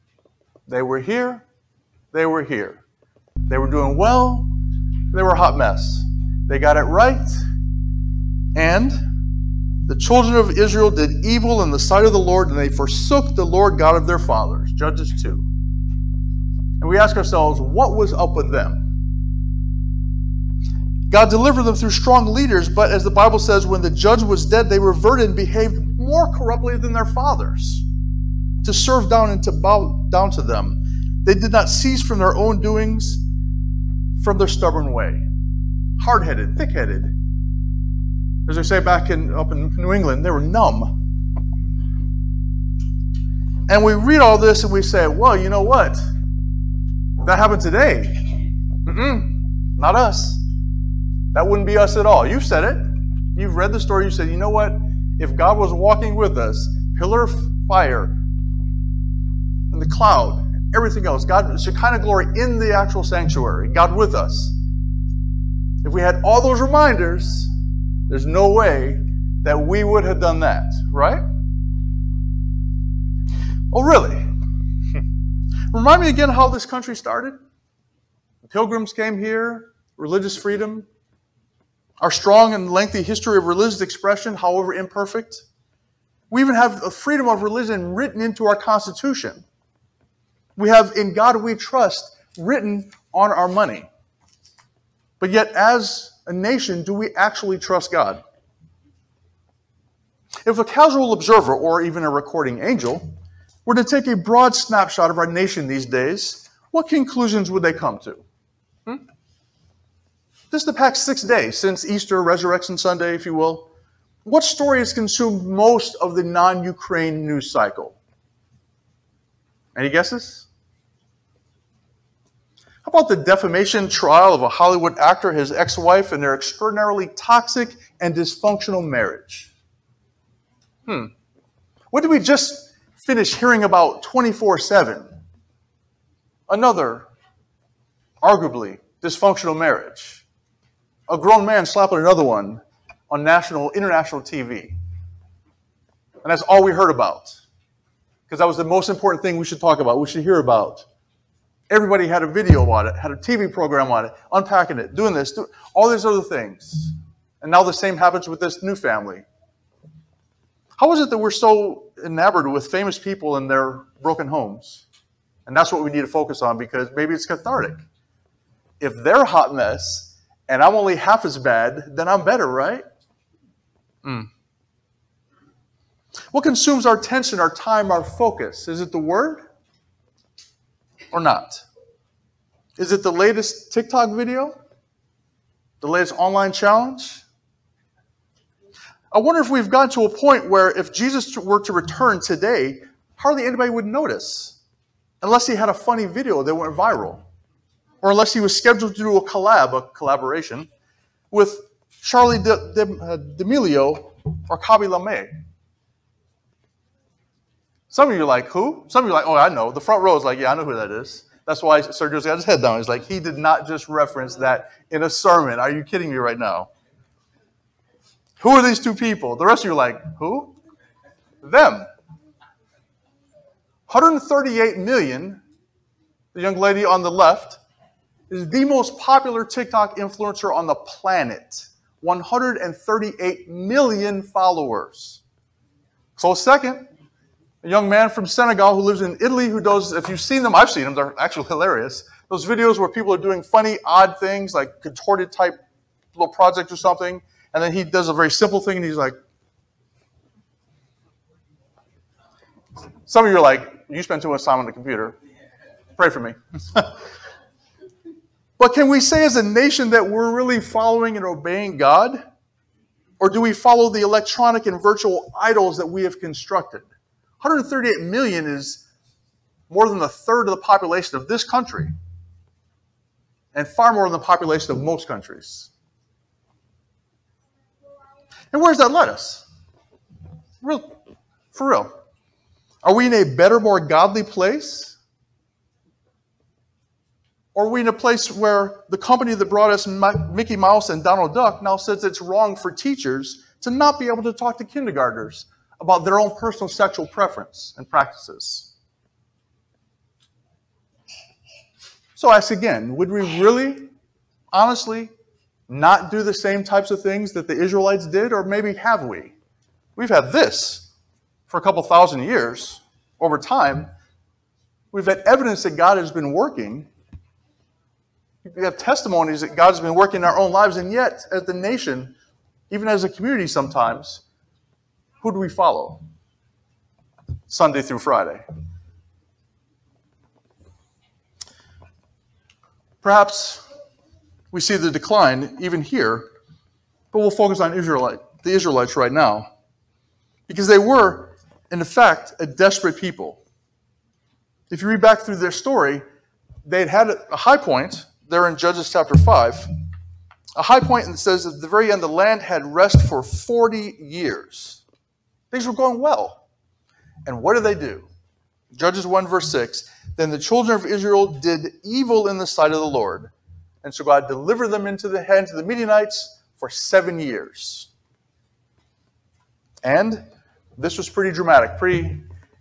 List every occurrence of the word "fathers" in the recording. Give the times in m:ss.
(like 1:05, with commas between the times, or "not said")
0:14, 0:27.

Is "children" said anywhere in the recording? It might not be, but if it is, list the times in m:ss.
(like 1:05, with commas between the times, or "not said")
0:09, 6:00.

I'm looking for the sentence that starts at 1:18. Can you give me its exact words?
The pilgrims came here, religious freedom, our strong and lengthy history of religious expression, however imperfect.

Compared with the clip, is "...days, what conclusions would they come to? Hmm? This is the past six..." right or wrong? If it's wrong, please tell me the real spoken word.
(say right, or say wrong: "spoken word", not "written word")
right.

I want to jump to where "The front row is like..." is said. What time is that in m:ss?
3:29.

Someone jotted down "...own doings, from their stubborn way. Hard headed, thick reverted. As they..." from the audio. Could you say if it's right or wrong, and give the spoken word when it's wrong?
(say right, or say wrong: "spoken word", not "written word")
wrong: "headed", not "reverted".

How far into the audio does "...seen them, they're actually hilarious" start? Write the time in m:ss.
4:00.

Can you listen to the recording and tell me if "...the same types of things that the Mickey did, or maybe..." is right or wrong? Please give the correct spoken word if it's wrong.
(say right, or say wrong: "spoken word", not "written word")
wrong: "Israelites", not "Mickey".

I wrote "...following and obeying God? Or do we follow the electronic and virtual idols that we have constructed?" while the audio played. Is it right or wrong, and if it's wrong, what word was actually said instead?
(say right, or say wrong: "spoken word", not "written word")
right.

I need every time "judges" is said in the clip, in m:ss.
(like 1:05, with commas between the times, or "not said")
0:14, 0:23, 5:48, 5:58.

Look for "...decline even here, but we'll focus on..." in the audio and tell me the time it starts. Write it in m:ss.
5:34.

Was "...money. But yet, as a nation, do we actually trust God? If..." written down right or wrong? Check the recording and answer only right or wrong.
right.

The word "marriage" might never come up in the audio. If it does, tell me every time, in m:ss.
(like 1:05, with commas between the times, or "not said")
2:08, 2:19.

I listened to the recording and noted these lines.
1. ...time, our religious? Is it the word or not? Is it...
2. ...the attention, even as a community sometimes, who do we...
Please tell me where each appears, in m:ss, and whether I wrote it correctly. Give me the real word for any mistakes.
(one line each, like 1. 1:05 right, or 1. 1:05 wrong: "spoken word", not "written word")
1. 2:57 wrong: "focus", not "religious"
2. 5:21 wrong: "nation", not "attention".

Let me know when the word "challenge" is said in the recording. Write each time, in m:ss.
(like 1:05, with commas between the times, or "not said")
3:06.